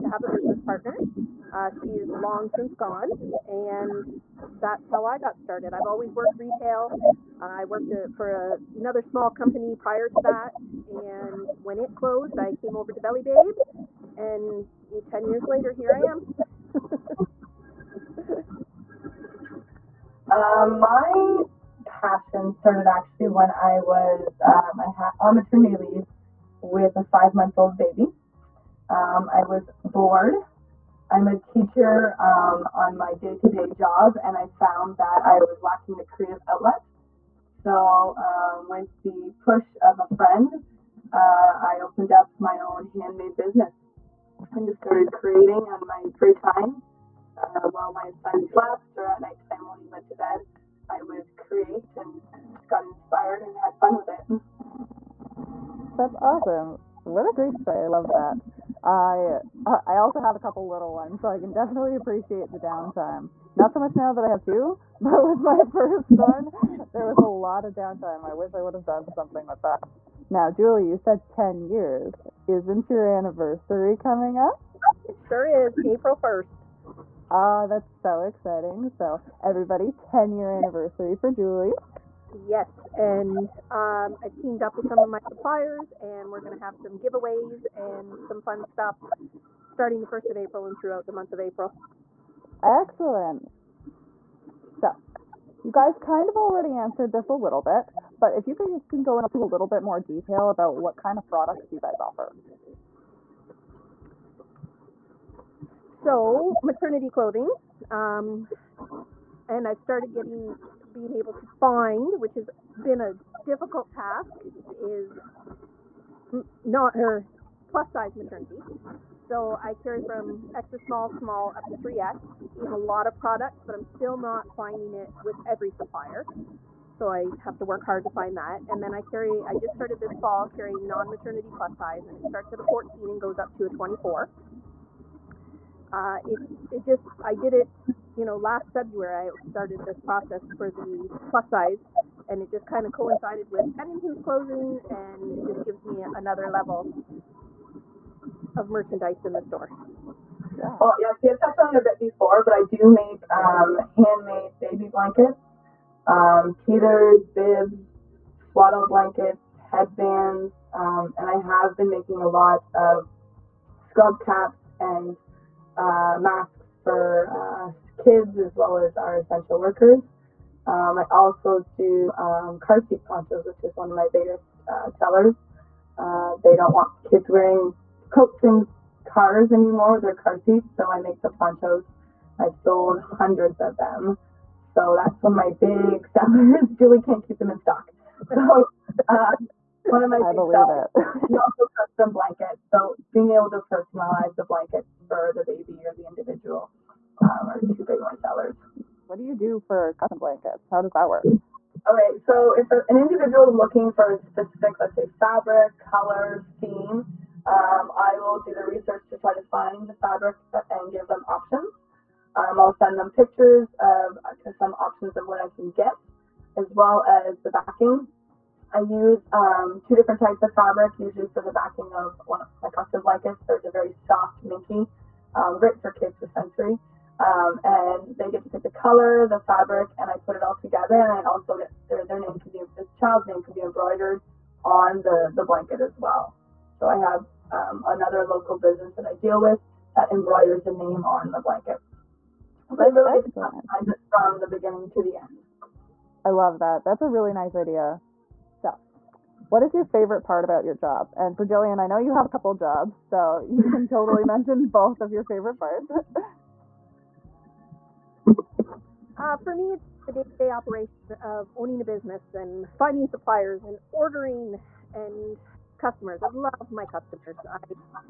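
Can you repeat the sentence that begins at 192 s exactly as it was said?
So being able to personalize the blankets for the baby or the individual um, are two big my sellers.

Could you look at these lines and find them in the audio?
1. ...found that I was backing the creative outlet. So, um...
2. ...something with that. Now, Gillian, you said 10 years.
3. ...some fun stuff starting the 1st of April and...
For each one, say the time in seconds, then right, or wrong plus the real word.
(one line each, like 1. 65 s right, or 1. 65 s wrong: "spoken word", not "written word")
1. 34 s wrong: "lacking", not "backing"
2. 69 s wrong: "Julie", not "Gillian"
3. 88 s right.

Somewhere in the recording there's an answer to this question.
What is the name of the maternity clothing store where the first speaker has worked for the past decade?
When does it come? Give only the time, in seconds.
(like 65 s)
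13 s.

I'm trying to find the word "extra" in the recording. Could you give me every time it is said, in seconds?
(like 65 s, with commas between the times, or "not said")
120 s.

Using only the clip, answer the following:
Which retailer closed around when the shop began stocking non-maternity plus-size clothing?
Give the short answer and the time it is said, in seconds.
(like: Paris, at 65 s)
Pennington's, at 143 s.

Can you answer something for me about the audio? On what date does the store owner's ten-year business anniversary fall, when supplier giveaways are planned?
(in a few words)
April 1st.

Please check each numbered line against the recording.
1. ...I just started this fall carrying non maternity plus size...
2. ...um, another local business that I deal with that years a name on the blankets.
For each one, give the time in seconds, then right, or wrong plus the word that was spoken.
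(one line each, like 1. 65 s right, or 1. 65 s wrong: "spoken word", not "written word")
1. 129 s right
2. 237 s wrong: "embroiders", not "years".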